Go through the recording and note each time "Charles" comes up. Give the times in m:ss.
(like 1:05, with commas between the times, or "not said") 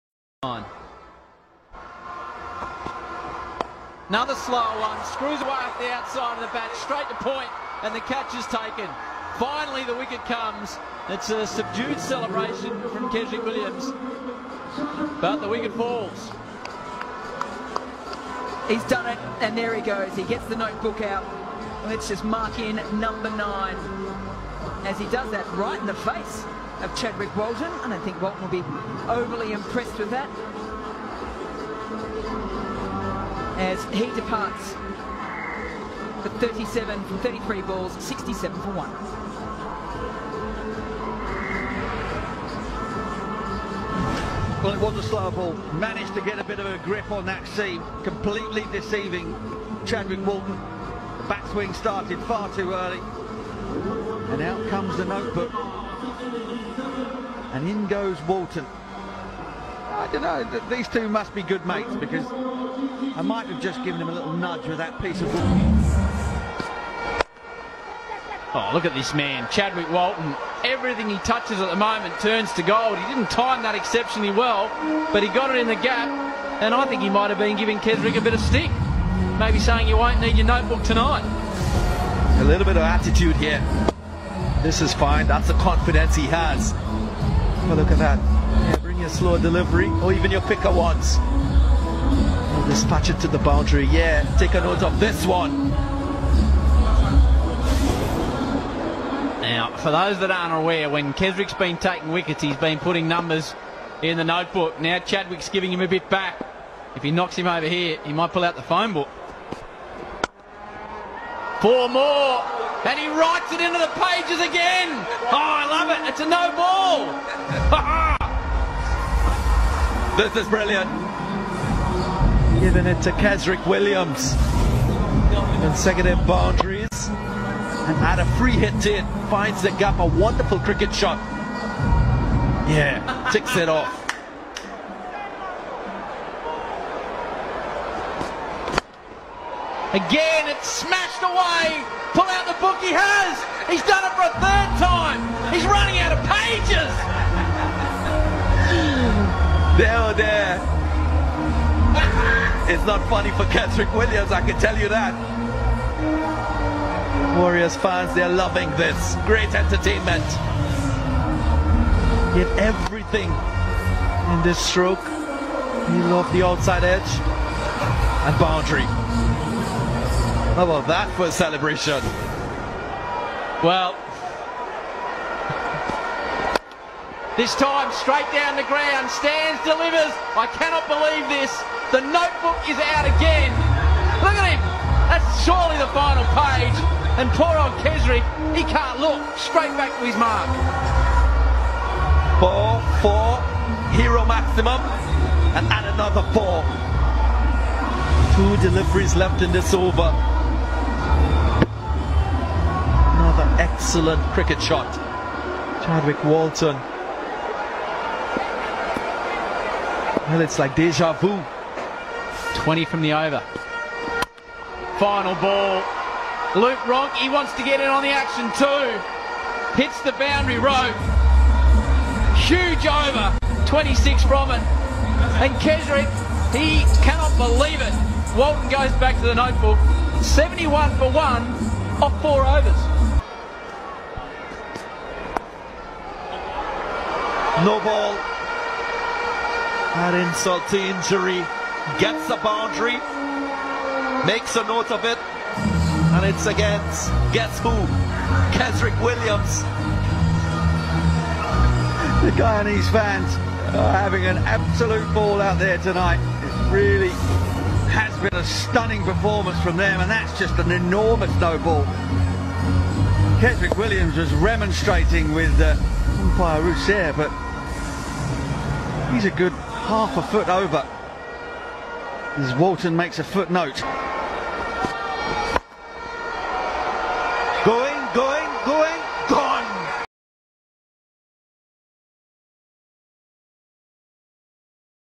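not said.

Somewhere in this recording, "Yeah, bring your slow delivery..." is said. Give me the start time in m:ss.
1:28.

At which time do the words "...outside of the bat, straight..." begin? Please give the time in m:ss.
0:05.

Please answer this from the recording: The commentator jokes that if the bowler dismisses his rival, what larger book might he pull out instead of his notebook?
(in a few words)
phone book.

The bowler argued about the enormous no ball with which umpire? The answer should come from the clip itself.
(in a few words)
Rousseau.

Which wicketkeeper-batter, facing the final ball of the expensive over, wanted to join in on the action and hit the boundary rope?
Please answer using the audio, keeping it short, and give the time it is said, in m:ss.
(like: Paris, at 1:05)
Luke Ronchi, at 3:36.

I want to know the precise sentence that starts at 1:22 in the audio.
A little bit of attitude here.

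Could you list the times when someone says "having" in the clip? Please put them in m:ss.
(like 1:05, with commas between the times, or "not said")
4:13.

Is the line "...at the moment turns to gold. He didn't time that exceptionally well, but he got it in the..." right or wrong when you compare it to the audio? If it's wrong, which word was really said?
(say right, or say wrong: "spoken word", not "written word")
right.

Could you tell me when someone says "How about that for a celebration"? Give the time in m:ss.
2:50.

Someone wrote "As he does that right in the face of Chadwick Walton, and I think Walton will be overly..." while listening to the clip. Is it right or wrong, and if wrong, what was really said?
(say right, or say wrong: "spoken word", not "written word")
right.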